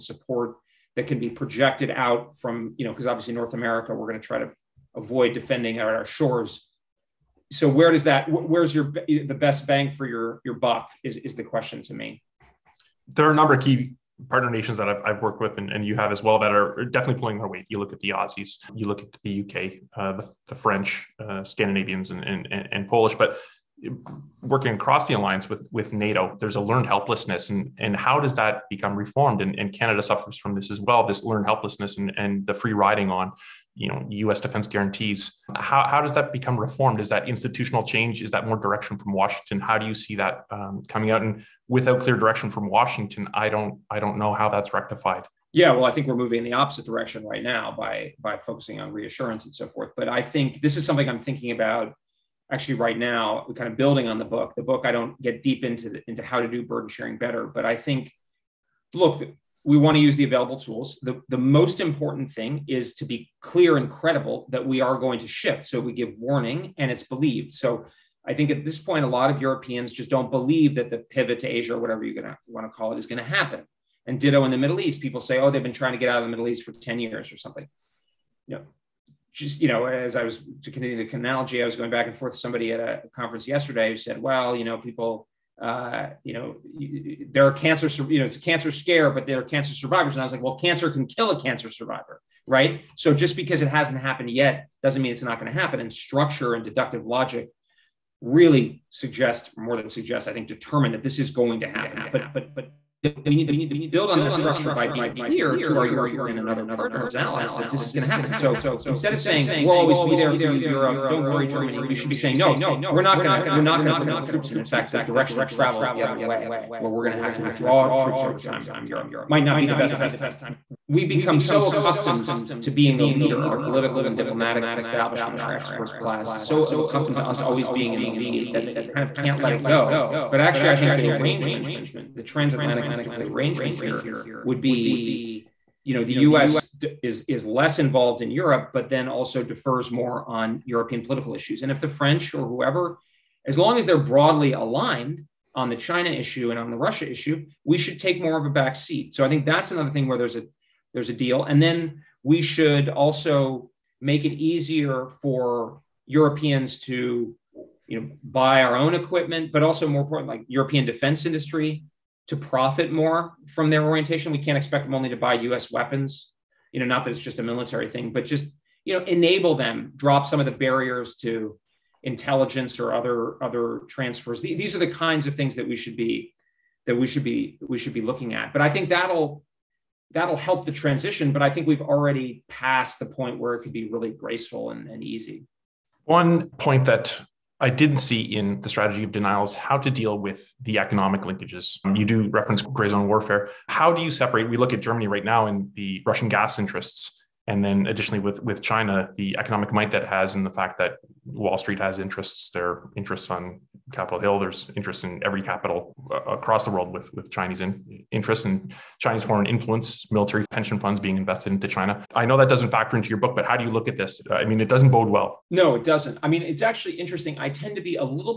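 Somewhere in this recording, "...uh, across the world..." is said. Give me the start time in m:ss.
3:26.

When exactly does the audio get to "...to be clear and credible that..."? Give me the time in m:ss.
1:02.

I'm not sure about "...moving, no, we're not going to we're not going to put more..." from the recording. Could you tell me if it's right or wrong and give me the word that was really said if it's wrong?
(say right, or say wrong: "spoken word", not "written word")
wrong: "saying", not "moving".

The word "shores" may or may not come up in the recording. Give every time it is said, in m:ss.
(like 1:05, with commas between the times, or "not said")
0:06.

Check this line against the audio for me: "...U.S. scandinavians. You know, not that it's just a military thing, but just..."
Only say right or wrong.
wrong.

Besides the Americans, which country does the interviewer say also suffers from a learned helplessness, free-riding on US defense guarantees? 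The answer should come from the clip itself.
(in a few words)
Canada.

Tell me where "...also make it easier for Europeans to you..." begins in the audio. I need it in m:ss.
2:32.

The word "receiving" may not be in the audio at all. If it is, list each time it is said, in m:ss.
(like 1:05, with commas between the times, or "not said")
not said.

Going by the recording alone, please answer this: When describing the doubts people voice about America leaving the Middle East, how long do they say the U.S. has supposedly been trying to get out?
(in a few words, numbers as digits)
10 years.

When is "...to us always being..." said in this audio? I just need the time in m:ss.
2:07.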